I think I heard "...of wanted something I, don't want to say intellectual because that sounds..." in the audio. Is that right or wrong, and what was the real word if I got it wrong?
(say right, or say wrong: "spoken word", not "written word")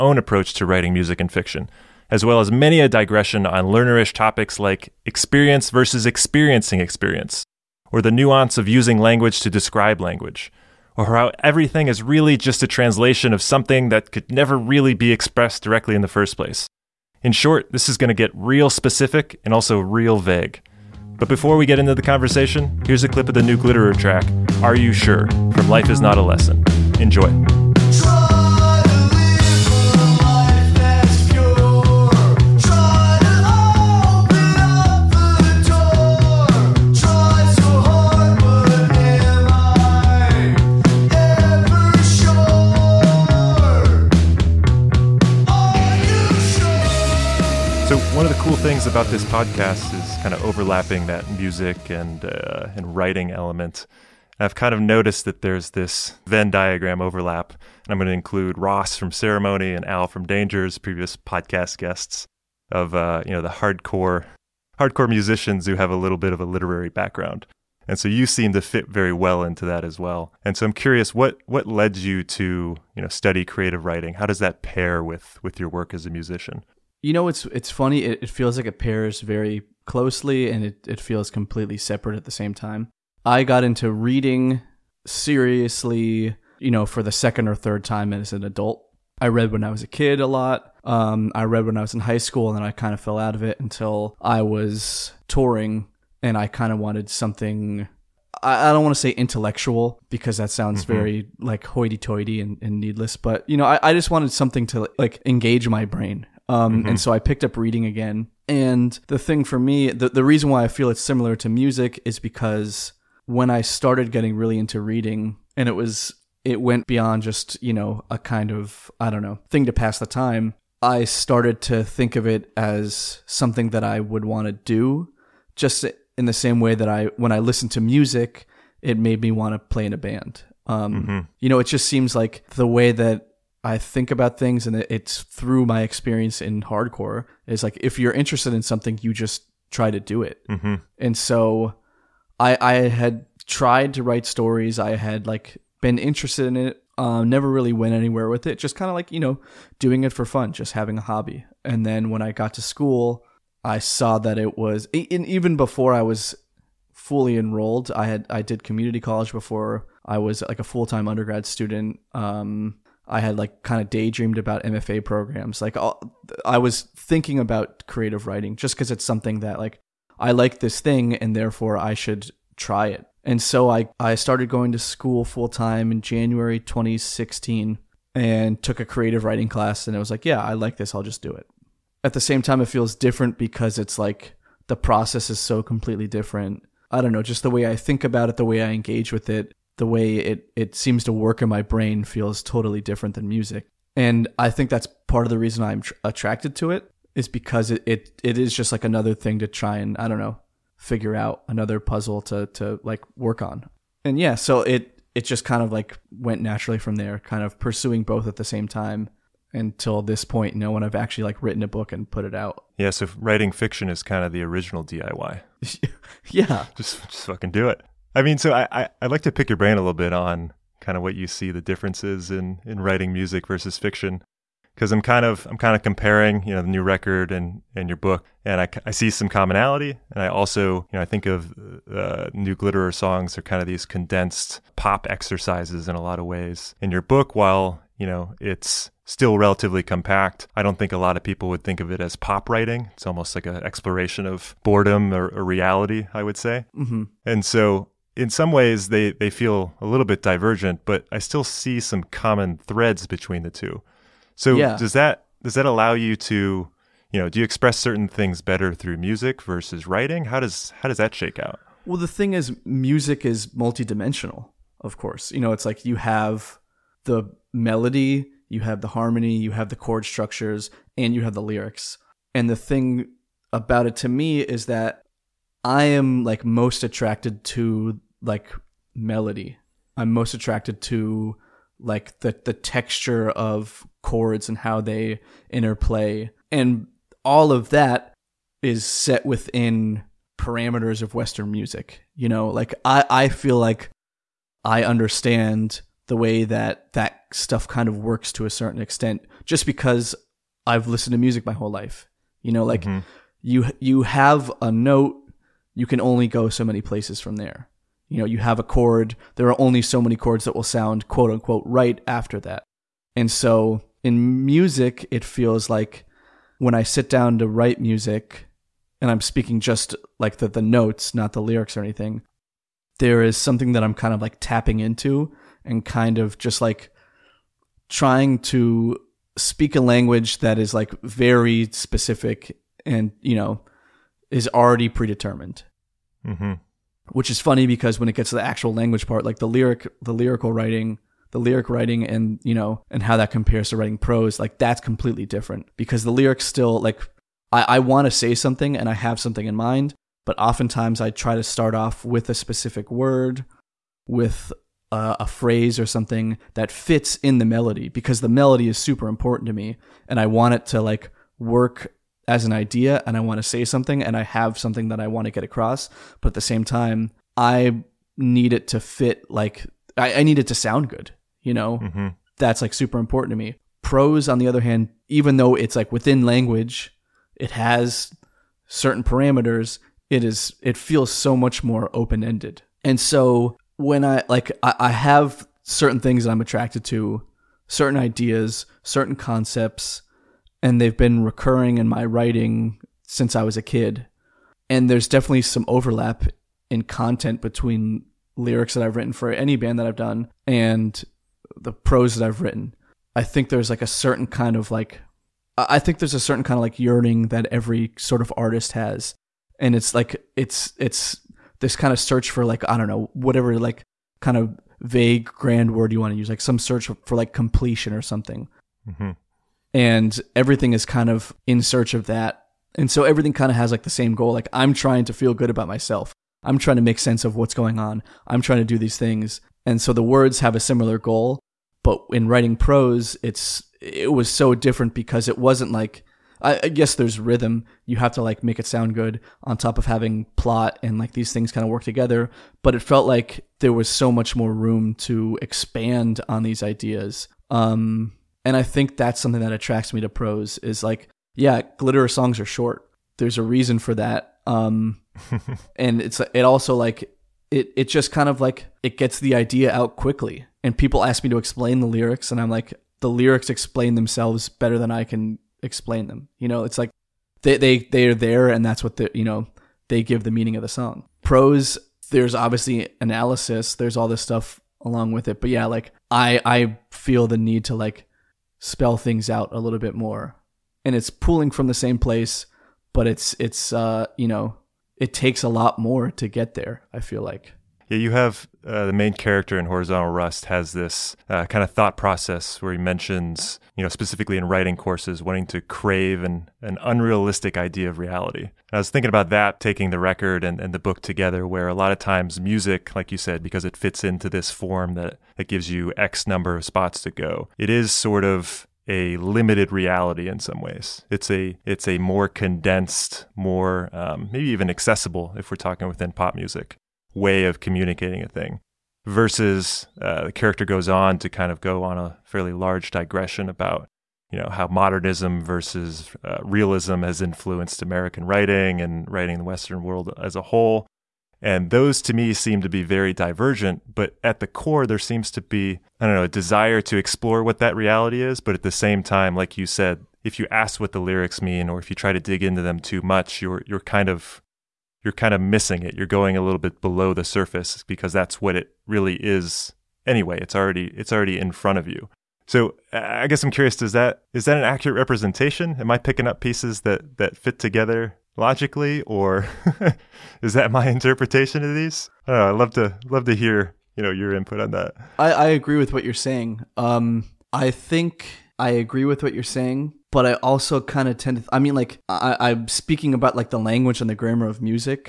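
right.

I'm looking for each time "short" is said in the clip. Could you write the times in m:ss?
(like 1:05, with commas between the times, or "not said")
0:17, 7:32.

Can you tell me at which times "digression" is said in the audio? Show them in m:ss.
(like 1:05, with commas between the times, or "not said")
0:02, 8:42.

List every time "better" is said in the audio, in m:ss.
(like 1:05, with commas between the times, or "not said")
4:18, 7:44.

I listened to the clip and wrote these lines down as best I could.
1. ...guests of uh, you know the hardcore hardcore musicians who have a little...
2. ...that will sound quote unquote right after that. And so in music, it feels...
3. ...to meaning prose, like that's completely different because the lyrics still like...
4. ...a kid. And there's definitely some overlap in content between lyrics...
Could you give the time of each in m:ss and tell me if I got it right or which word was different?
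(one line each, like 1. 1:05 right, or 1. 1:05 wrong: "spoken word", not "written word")
1. 1:01 right
2. 5:10 right
3. 5:43 wrong: "writing", not "meaning"
4. 6:33 right.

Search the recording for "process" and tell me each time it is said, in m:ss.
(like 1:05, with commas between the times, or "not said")
3:04, 8:11.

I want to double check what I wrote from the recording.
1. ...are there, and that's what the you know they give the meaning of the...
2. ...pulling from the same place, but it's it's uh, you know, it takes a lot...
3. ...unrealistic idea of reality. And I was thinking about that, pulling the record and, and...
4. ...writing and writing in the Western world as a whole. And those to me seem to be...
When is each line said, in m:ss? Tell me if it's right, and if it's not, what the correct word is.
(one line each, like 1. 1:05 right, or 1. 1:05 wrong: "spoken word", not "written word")
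1. 7:48 right
2. 8:01 right
3. 8:16 wrong: "taking", not "pulling"
4. 8:48 right.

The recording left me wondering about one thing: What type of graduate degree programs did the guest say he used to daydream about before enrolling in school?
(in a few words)
MFA programs.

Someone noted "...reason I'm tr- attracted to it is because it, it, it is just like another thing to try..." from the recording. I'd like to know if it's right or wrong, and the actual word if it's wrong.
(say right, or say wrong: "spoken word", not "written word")
right.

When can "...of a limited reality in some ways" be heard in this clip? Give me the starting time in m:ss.
8:28.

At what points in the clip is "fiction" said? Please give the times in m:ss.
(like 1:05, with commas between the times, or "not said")
0:01, 3:33, 3:43.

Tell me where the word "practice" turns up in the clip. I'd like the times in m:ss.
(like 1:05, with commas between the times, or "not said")
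not said.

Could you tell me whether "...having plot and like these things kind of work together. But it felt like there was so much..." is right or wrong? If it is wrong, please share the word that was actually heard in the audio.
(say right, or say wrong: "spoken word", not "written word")
right.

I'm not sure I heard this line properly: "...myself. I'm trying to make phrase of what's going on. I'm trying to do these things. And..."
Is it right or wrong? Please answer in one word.
wrong.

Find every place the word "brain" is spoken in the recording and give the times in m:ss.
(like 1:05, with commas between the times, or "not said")
1:45, 3:11, 3:39.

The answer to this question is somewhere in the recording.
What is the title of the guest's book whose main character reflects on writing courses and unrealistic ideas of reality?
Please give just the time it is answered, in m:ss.
8:09.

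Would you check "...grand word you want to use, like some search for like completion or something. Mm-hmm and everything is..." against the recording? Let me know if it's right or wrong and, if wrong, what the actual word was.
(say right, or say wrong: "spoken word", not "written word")
right.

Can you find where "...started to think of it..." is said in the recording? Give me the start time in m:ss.
2:01.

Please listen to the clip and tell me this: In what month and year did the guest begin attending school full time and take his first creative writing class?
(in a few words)
January 2016.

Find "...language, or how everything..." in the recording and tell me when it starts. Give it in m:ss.
0:10.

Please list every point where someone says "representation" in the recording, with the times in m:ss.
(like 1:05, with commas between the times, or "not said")
9:14.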